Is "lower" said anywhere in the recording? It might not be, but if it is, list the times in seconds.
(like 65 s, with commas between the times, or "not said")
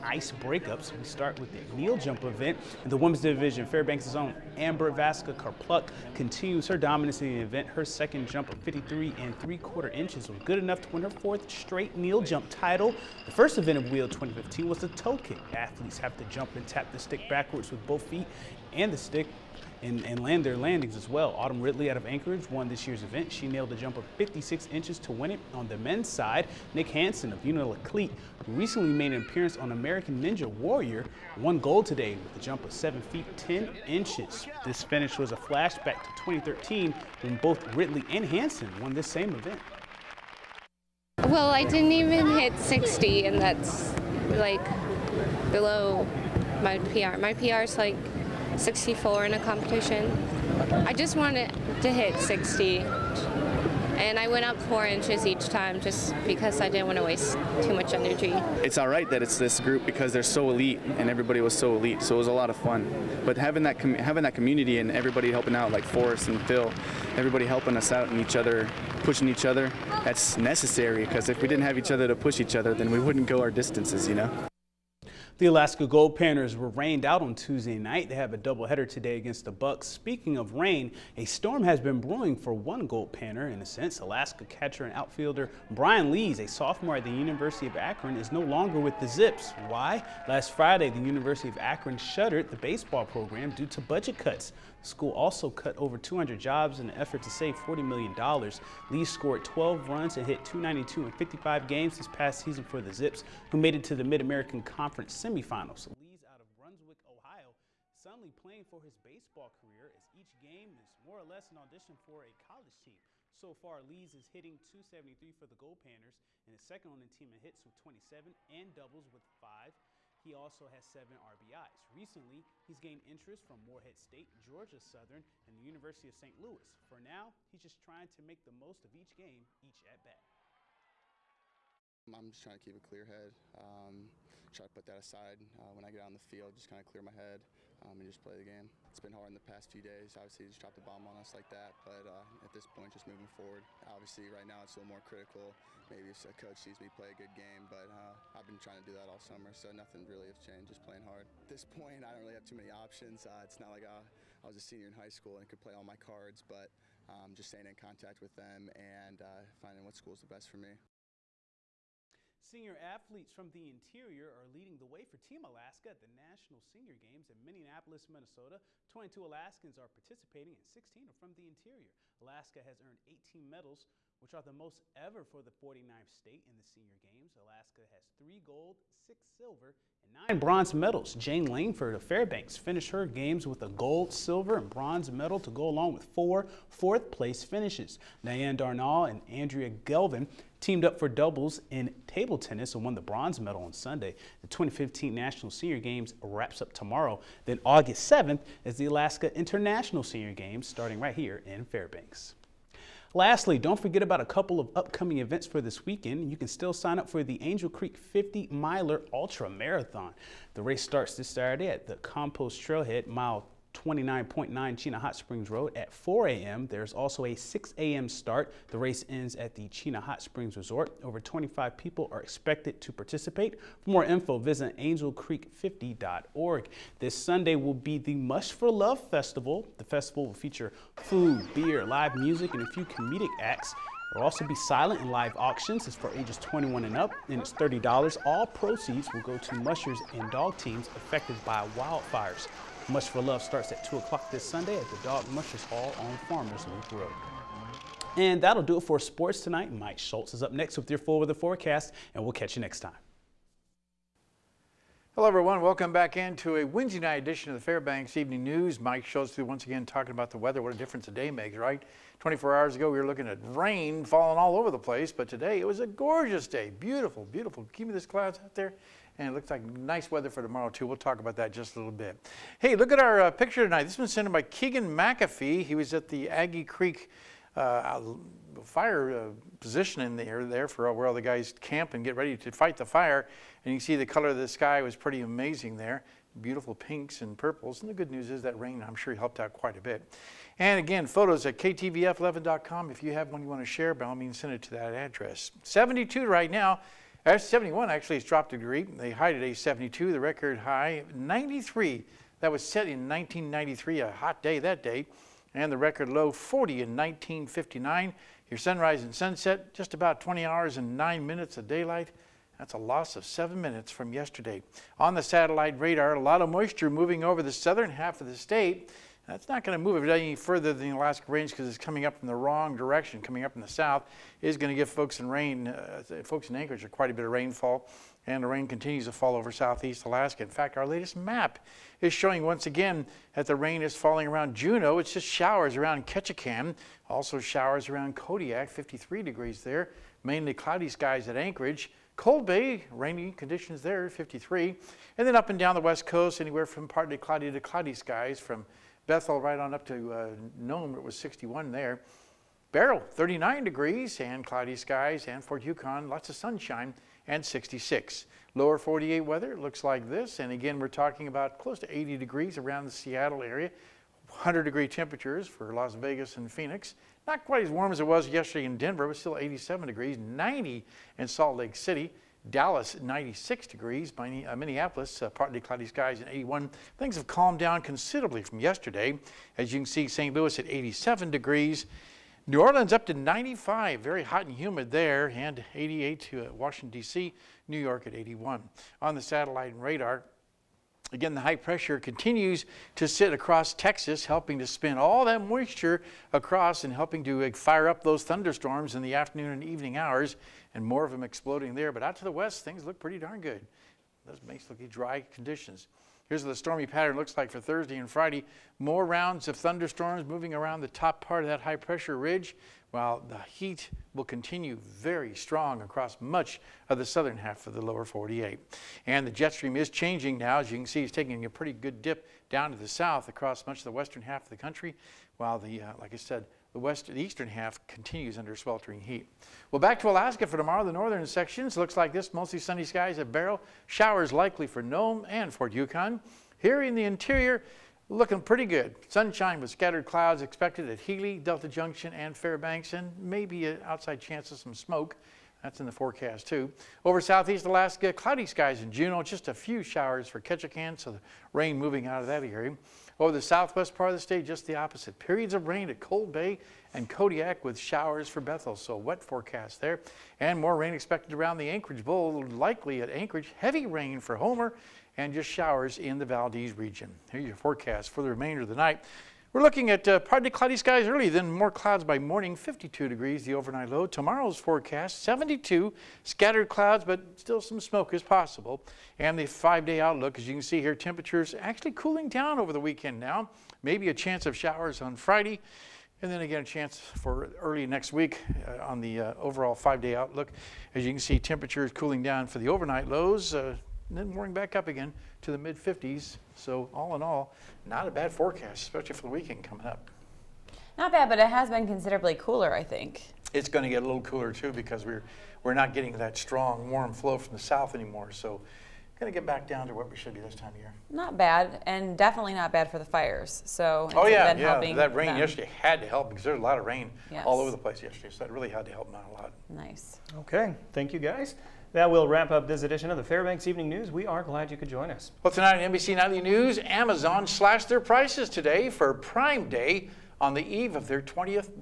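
358 s, 417 s.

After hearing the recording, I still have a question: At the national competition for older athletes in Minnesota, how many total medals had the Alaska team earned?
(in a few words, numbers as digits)
18.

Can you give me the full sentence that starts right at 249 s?
Mike Schultz is up next with your full weather forecast, and we'll catch you next time.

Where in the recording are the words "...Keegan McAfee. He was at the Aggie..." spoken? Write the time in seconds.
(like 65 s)
274 s.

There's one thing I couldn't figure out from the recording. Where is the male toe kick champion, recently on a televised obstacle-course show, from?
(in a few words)
Unalakleet.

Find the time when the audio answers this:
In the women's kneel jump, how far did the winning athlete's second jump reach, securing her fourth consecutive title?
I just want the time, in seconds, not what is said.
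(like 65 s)
8 s.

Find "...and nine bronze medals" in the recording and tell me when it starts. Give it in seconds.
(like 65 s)
180 s.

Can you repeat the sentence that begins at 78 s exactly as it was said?
They have a doubleheader today against the Bucks.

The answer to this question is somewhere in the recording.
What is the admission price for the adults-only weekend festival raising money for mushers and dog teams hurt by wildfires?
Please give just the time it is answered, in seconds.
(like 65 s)
237 s.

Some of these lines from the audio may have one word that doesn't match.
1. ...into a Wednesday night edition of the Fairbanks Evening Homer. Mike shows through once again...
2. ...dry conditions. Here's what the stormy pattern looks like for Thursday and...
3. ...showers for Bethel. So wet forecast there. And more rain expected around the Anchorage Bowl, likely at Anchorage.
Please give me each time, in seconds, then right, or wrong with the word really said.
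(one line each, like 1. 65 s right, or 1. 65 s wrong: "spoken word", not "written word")
1. 256 s wrong: "News", not "Homer"
2. 404 s right
3. 457 s right.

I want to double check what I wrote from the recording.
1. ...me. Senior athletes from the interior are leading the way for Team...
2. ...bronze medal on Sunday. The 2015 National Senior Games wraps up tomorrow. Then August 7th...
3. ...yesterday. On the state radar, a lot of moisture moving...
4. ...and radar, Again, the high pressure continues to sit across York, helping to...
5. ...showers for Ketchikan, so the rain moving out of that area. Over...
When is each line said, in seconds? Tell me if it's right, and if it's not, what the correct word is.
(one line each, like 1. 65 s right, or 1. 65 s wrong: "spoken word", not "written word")
1. 160 s right
2. 193 s right
3. 314 s wrong: "satellite", not "state"
4. 389 s wrong: "Texas", not "York"
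5. 449 s right.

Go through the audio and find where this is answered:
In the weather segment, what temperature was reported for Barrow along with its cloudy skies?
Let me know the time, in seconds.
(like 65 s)
352 s.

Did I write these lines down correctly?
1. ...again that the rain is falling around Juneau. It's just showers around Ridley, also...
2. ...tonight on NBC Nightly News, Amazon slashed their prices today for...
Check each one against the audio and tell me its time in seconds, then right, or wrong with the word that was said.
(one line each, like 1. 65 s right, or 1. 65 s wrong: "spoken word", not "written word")
1. 332 s wrong: "Ketchikan", not "Ridley"
2. 525 s right.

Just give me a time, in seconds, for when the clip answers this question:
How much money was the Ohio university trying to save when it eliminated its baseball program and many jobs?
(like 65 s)
97 s.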